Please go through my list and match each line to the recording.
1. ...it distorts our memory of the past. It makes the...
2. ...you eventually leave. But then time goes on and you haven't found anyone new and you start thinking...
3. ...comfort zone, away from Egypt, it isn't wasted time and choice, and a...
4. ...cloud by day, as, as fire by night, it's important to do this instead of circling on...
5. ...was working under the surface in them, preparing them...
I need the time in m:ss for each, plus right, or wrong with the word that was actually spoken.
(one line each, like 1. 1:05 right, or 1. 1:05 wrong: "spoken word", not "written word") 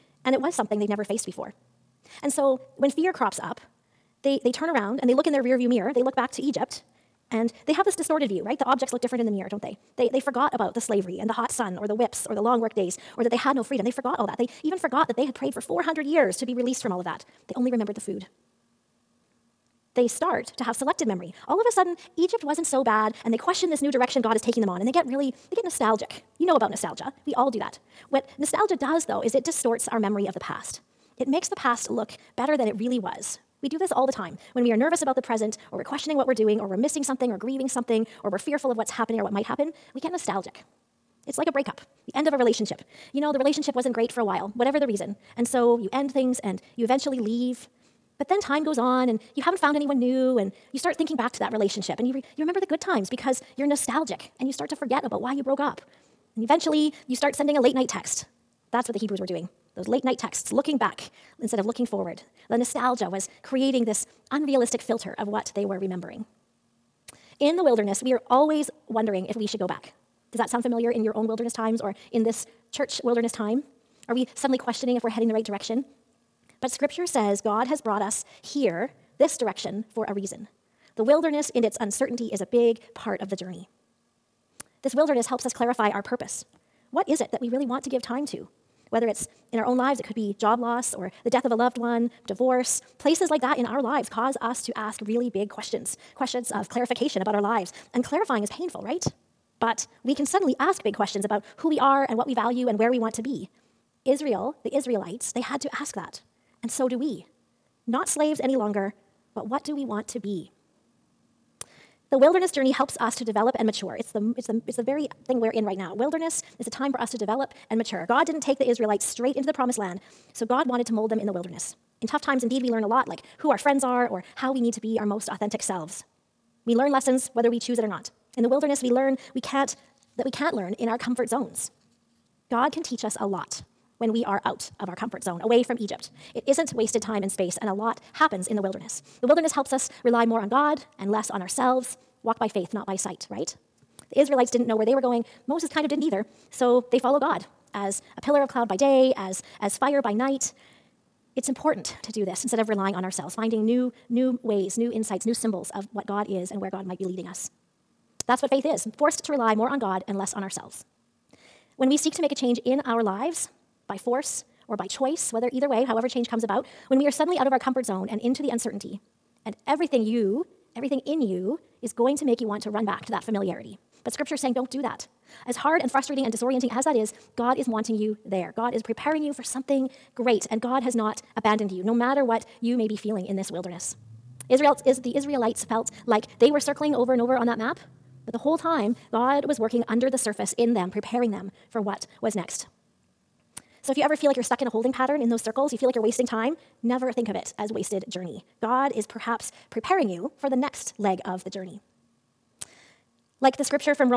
1. 0:29 right
2. 0:46 right
3. 2:14 wrong: "space", not "choice"
4. 2:28 wrong: "relying", not "circling"
5. 3:09 right.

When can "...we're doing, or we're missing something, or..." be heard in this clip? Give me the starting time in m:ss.
0:36.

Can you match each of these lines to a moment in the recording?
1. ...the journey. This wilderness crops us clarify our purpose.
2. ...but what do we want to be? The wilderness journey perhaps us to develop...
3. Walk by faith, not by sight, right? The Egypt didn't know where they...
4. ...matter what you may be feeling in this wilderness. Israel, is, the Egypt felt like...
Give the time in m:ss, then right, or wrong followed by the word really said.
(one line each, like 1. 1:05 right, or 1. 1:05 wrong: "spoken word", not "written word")
1. 1:23 wrong: "helps", not "crops"
2. 1:49 wrong: "helps", not "perhaps"
3. 2:22 wrong: "Israelites", not "Egypt"
4. 3:01 wrong: "Israelites", not "Egypt".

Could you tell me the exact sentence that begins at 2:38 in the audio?
That's what faith is forced to rely more on God and less on ourselves.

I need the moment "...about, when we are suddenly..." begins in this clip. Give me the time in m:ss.
2:46.